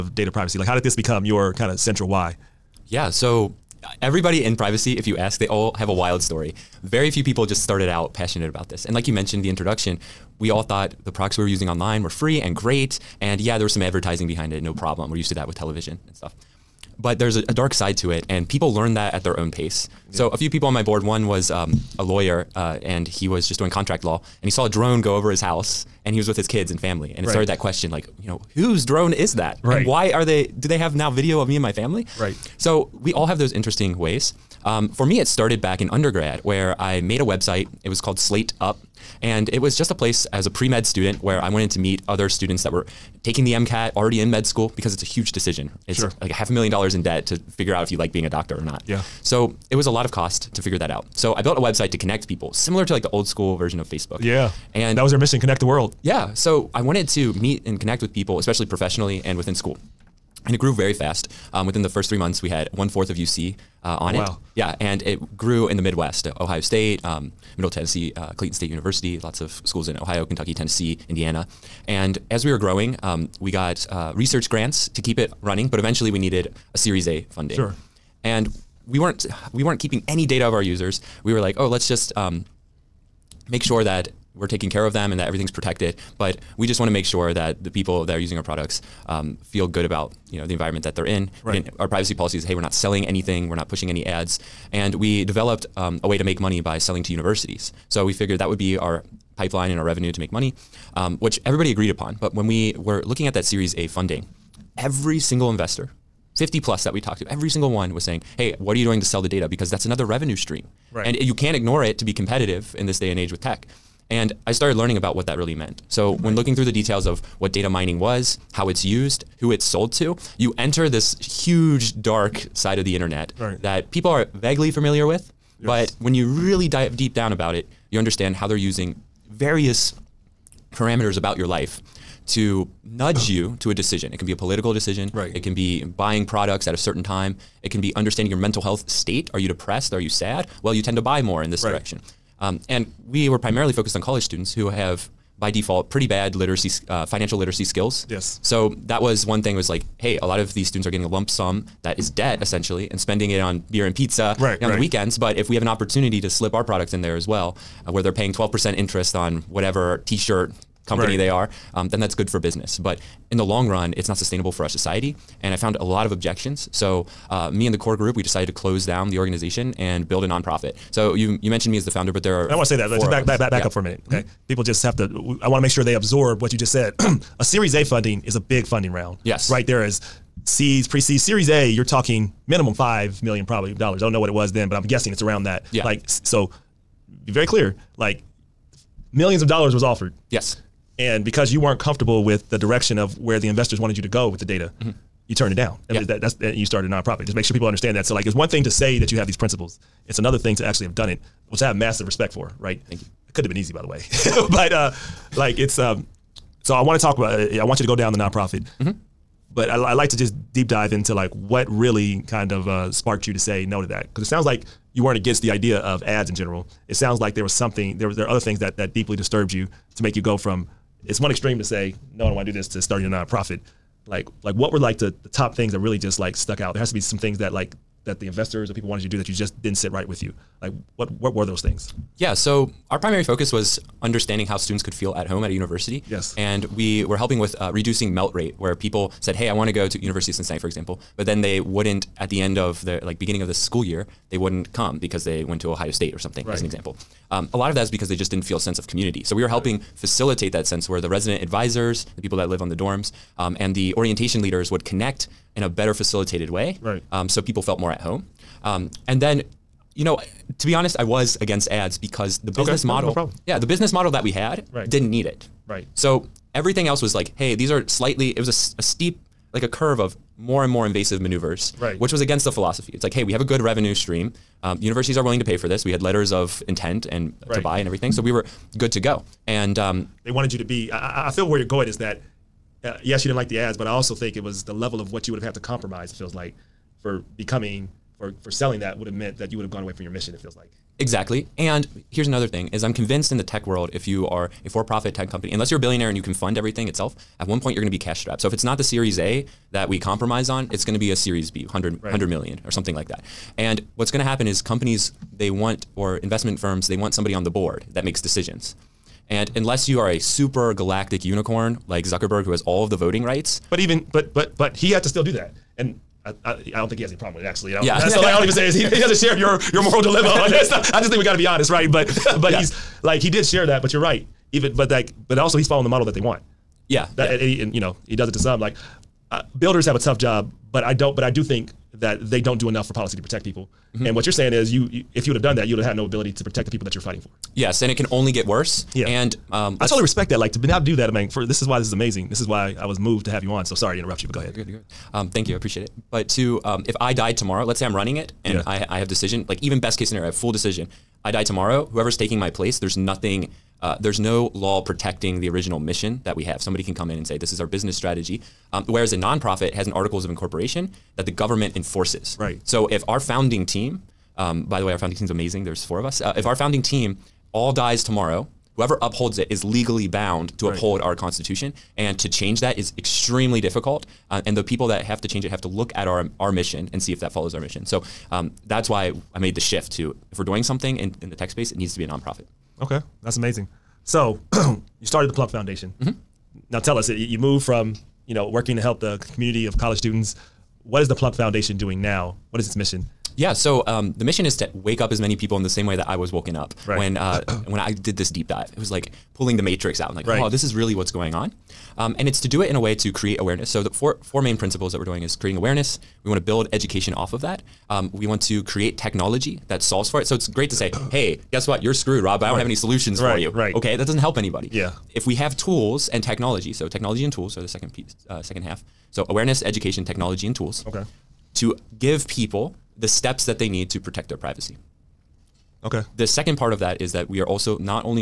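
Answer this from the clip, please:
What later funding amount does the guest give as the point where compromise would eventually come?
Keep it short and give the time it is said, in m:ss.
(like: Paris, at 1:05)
100 million, at 5:02.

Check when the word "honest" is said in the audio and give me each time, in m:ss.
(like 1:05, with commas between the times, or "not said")
4:20, 5:21.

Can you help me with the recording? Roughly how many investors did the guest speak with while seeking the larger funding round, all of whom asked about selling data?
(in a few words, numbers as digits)
50 plus.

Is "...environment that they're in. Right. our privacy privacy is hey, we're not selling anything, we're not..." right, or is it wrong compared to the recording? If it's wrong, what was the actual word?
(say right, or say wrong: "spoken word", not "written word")
wrong: "policy", not "privacy".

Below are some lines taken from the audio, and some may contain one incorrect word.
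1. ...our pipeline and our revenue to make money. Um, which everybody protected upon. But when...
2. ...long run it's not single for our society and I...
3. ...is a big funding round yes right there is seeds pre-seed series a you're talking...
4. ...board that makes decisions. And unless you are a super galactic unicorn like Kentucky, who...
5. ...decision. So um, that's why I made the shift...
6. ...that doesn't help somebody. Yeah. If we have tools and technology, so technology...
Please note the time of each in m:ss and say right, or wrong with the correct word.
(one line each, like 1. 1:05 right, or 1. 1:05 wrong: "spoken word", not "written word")
1. 1:38 wrong: "agreed", not "protected"
2. 2:43 wrong: "sustainable", not "single"
3. 2:58 right
4. 5:07 wrong: "Zuckerberg", not "Kentucky"
5. 6:17 wrong: "mission", not "decision"
6. 6:53 wrong: "anybody", not "somebody".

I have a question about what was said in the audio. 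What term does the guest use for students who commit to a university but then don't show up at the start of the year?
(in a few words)
Melt rate.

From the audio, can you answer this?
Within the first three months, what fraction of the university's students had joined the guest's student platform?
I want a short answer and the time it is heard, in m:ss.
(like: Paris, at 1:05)
One fourth, at 1:02.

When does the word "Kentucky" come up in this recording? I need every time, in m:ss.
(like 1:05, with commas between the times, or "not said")
1:10.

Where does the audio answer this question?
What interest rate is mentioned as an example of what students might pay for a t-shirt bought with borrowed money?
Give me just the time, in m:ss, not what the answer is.
2:38.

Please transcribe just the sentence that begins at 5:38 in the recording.
Yeah, and um, I totally respect that.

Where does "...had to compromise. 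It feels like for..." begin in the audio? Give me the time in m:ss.
4:45.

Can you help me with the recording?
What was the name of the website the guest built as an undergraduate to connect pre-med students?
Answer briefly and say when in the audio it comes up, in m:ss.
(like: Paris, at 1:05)
Slate Up, at 0:38.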